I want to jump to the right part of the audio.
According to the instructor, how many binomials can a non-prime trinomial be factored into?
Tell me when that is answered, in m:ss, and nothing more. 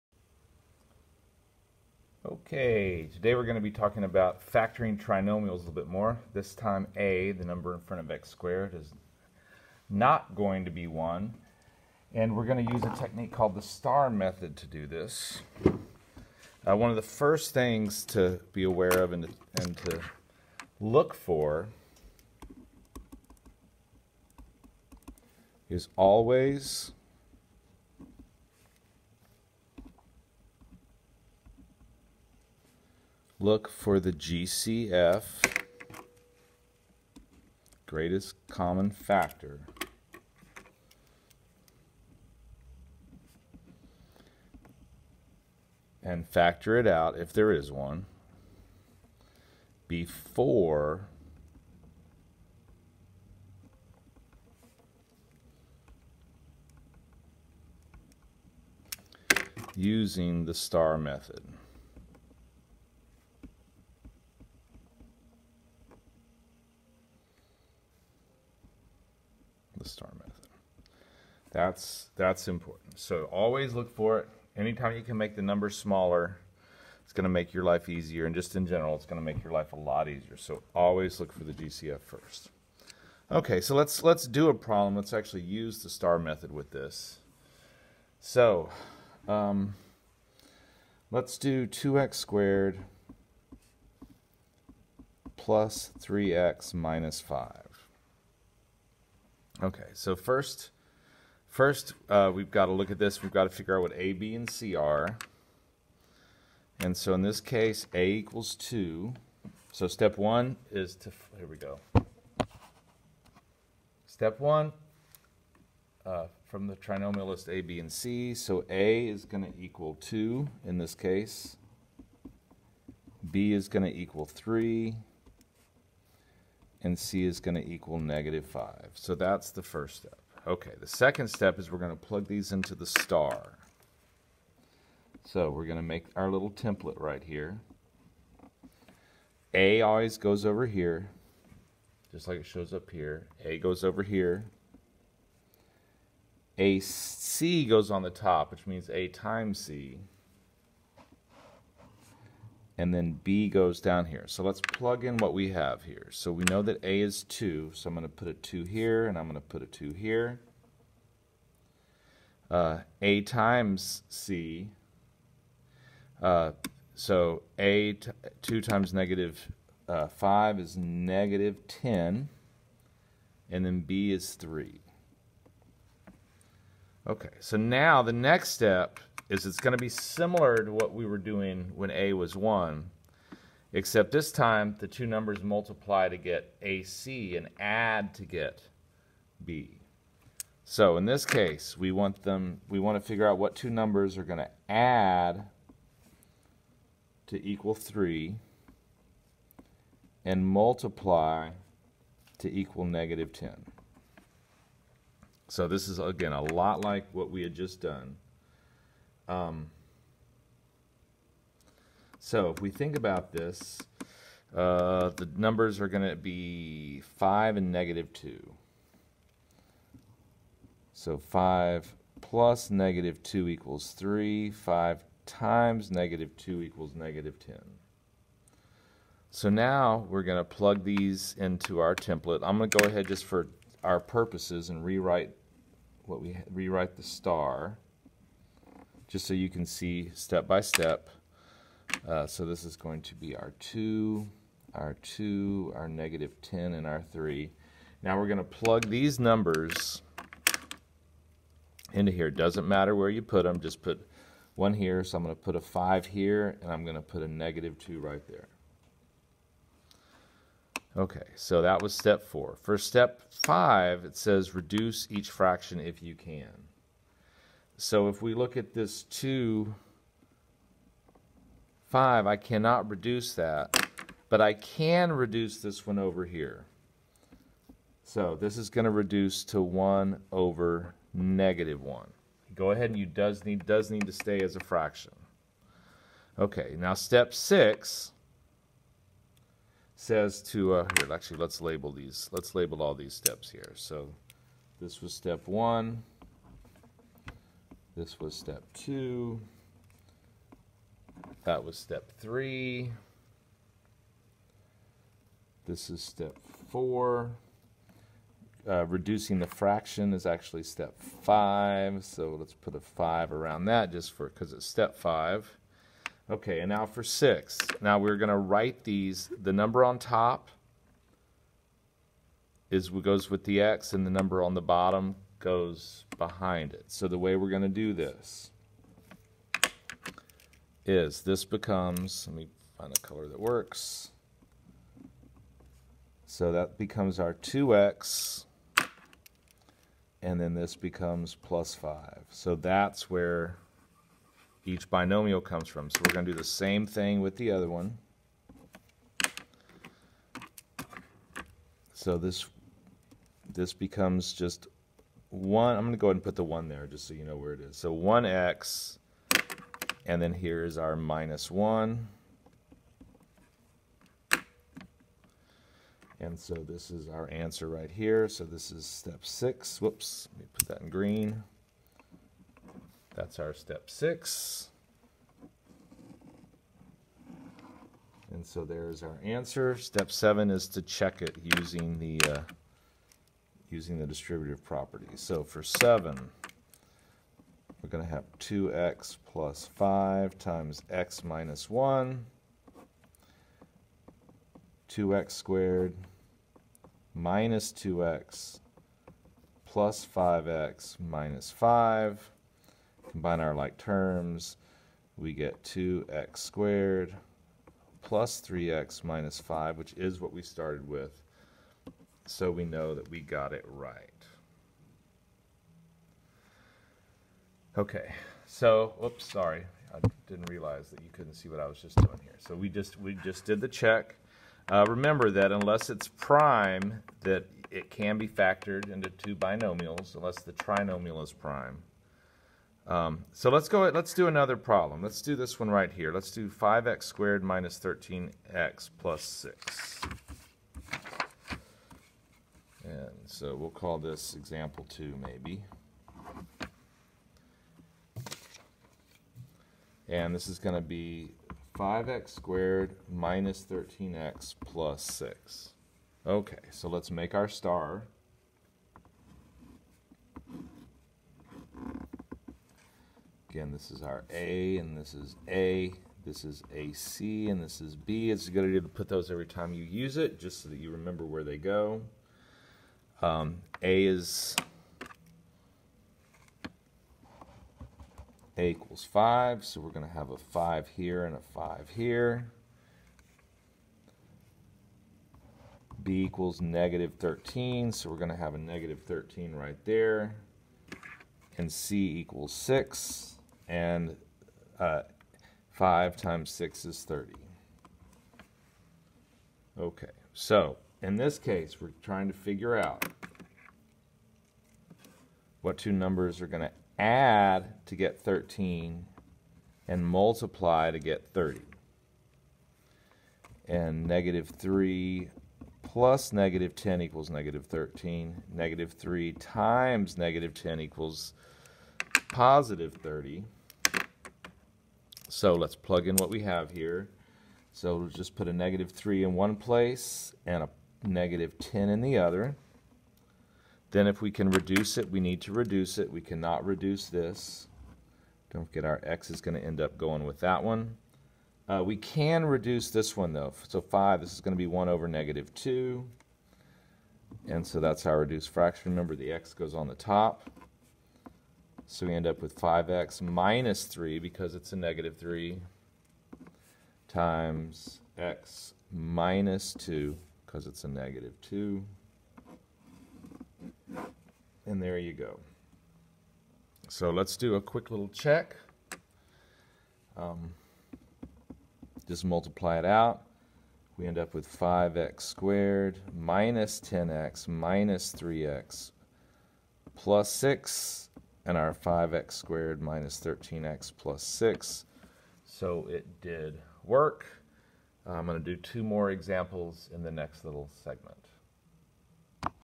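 7:09.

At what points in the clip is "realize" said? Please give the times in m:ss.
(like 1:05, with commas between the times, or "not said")
7:00.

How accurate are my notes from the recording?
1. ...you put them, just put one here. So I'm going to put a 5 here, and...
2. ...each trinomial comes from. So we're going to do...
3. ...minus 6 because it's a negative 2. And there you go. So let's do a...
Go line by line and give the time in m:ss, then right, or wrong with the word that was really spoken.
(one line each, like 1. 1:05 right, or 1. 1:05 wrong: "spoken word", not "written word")
1. 4:13 right
2. 5:44 wrong: "binomial", not "trinomial"
3. 9:18 wrong: "2", not "6".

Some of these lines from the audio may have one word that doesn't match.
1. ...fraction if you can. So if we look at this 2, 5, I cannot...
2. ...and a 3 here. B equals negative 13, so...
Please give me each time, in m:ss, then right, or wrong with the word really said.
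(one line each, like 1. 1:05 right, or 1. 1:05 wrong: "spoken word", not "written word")
1. 4:25 right
2. 8:01 wrong: "5", not "3".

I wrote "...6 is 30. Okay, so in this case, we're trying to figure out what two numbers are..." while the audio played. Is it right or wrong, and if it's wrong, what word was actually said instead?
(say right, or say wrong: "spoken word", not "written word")
right.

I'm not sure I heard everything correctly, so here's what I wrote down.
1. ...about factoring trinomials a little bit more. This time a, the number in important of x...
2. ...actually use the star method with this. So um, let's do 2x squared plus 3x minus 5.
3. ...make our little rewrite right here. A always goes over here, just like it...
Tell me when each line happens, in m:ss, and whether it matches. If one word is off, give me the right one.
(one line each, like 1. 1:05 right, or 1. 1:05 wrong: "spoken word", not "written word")
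1. 0:04 wrong: "front", not "important"
2. 1:25 right
3. 2:15 wrong: "template", not "rewrite".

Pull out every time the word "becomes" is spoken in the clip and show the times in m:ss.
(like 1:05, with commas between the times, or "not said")
5:31, 5:36, 5:40, 5:53.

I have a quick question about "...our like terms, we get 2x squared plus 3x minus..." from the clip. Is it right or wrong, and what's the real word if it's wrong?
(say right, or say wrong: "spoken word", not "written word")
right.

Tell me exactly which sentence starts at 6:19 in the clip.
Step seven is to check it using the uh, using the distributive property.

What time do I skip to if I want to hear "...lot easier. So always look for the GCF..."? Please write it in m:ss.
1:19.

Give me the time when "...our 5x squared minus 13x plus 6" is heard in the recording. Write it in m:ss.
9:41.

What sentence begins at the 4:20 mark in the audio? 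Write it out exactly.
Okay, so that was step four.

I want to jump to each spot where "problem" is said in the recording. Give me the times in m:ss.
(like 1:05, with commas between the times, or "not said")
1:24, 7:14.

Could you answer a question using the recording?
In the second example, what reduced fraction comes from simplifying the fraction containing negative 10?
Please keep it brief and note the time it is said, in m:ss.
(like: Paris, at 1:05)
1 over -2, at 9:04.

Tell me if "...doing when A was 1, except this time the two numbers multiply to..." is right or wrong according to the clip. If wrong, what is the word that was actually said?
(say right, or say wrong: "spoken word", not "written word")
right.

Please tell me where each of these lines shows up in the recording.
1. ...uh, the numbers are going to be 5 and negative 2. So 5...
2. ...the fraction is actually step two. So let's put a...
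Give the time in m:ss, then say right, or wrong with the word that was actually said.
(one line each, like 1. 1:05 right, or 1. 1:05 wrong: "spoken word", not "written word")
1. 3:34 right
2. 5:09 wrong: "five", not "two".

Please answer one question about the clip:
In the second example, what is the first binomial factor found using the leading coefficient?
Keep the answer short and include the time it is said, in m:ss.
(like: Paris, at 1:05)
5x - 3, at 9:12.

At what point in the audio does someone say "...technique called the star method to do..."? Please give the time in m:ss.
0:12.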